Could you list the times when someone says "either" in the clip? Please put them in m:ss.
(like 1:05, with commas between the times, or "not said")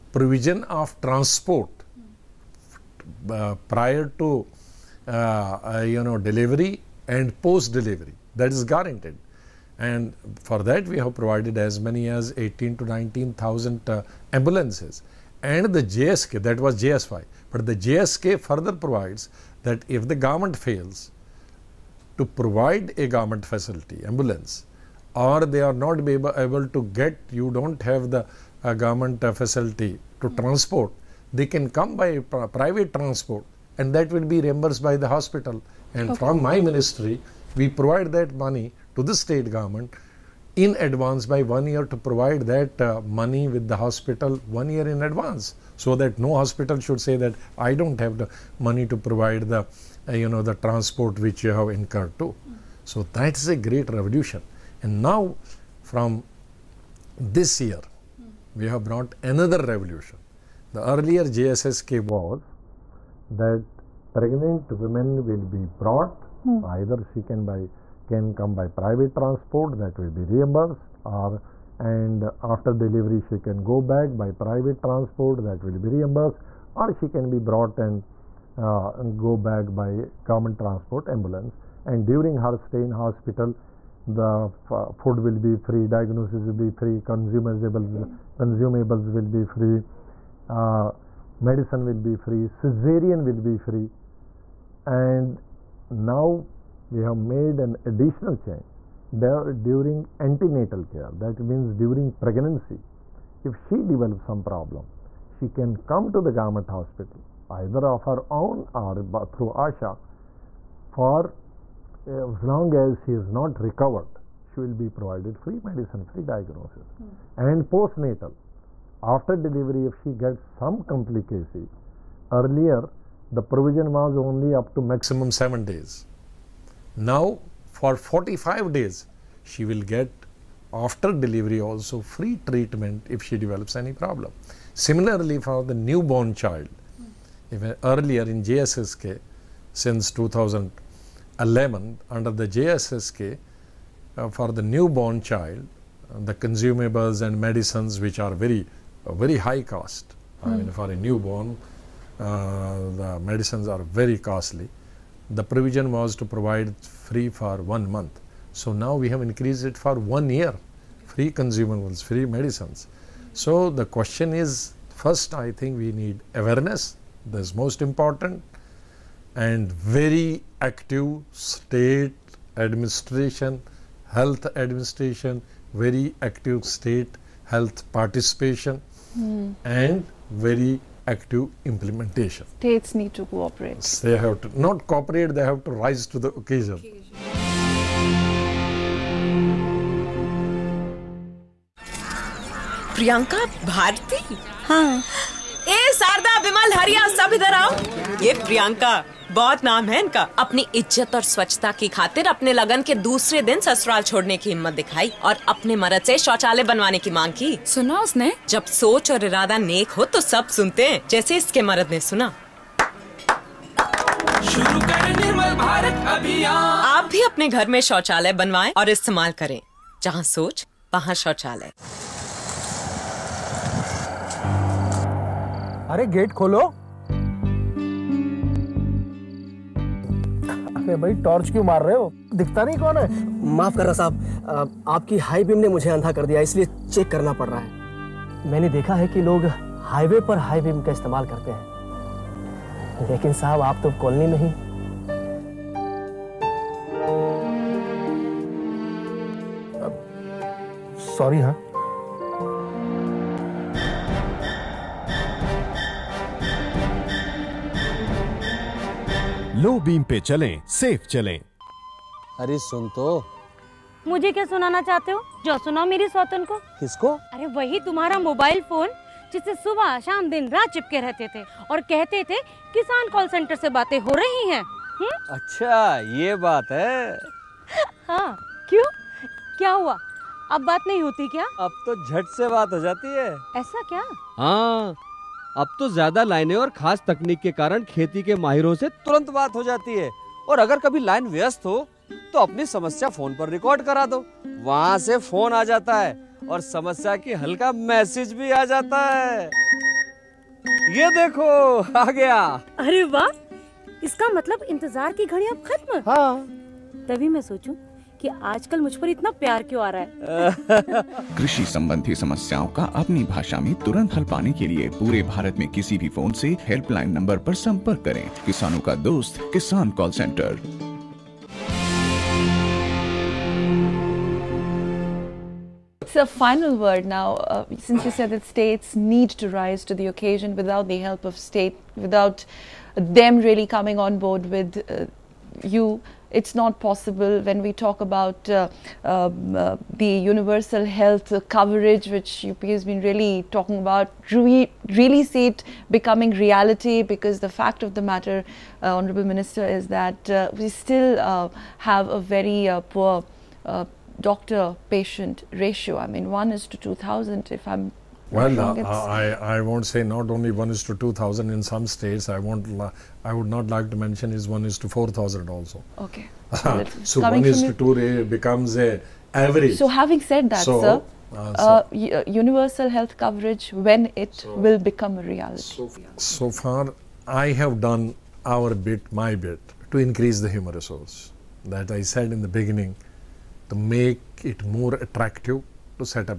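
1:06, 1:47.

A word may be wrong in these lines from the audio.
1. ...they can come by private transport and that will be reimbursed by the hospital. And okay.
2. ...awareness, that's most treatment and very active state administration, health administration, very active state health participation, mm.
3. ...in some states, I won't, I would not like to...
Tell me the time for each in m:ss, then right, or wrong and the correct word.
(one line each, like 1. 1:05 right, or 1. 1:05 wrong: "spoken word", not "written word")
1. 0:31 right
2. 2:46 wrong: "important", not "treatment"
3. 6:01 right.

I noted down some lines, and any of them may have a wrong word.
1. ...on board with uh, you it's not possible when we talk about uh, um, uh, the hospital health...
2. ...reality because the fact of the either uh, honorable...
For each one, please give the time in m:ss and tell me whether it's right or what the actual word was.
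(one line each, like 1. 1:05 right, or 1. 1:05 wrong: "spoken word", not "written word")
1. 5:34 wrong: "universal", not "hospital"
2. 5:46 wrong: "matter", not "either".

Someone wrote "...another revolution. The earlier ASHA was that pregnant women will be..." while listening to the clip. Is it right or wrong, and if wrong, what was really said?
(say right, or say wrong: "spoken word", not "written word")
wrong: "JSSK", not "ASHA".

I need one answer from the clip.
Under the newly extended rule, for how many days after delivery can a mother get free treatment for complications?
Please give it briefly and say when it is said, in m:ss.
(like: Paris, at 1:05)
45 days, at 2:07.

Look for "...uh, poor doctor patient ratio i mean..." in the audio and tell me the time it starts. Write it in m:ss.
5:52.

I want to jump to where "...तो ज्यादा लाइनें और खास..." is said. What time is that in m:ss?
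4:45.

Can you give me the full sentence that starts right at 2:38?
So now we have increased it for one year, free consumables, free medicines.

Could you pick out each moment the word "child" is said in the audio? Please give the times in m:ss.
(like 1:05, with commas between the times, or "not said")
2:16, 2:25.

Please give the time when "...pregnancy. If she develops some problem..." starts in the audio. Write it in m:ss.
1:42.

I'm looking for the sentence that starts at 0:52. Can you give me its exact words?
Mm So that's a great revolution.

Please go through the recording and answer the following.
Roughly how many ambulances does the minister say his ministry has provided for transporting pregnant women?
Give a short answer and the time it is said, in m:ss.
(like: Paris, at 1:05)
18 to 19,000, at 0:12.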